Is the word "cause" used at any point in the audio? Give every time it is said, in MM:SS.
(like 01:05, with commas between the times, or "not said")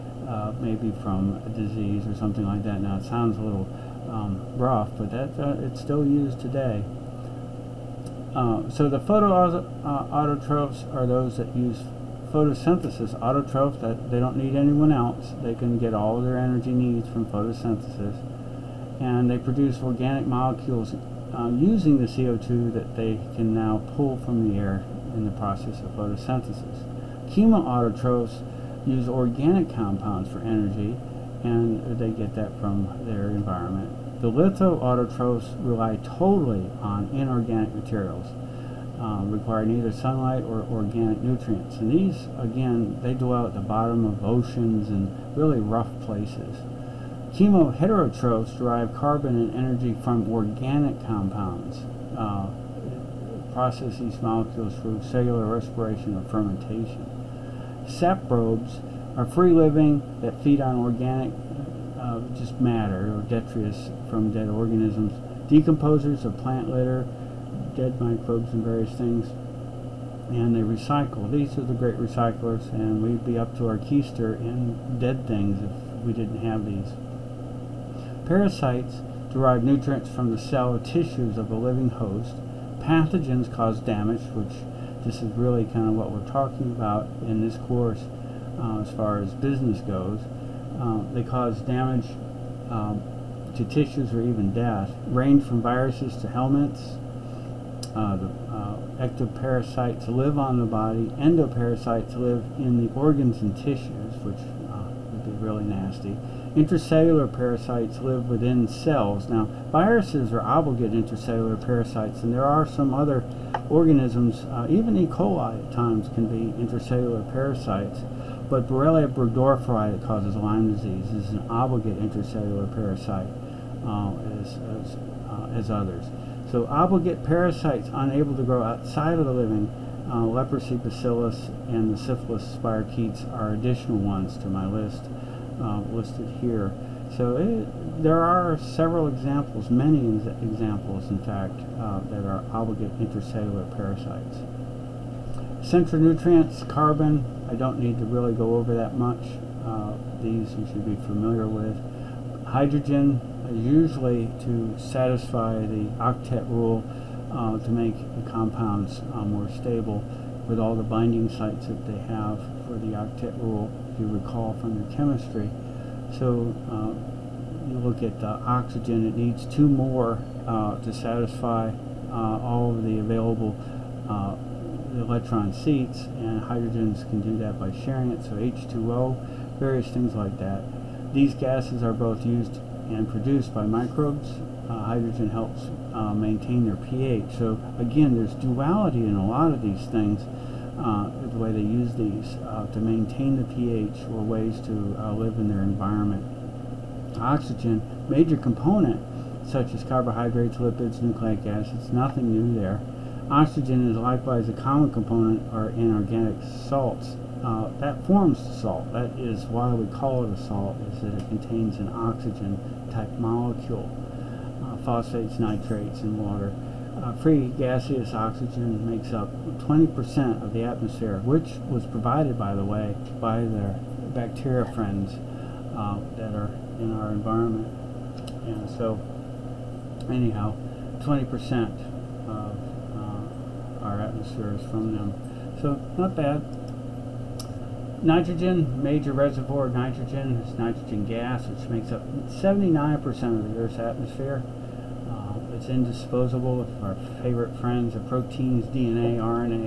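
01:23, 01:31, 02:00.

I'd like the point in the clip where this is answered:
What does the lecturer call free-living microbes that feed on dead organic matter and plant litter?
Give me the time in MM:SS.
00:57.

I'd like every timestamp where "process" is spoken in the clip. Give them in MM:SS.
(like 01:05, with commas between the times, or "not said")
00:25, 00:53.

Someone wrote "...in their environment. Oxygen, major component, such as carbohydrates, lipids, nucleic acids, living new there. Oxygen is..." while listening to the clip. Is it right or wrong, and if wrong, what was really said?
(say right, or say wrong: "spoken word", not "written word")
wrong: "nothing", not "living".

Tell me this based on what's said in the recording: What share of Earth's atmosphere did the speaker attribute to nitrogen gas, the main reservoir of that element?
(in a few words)
79%.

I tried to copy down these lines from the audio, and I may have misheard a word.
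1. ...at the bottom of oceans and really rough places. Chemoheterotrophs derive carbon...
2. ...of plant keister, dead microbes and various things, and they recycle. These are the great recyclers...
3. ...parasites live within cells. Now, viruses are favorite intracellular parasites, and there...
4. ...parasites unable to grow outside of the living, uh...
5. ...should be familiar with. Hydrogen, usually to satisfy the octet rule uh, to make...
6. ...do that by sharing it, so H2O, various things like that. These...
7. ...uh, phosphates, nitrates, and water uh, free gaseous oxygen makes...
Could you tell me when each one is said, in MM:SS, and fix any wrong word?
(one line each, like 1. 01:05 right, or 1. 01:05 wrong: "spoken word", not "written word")
1. 00:43 right
2. 01:06 wrong: "litter", not "keister"
3. 01:47 wrong: "obligate", not "favorite"
4. 02:07 right
5. 02:30 right
6. 02:57 right
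7. 03:34 right.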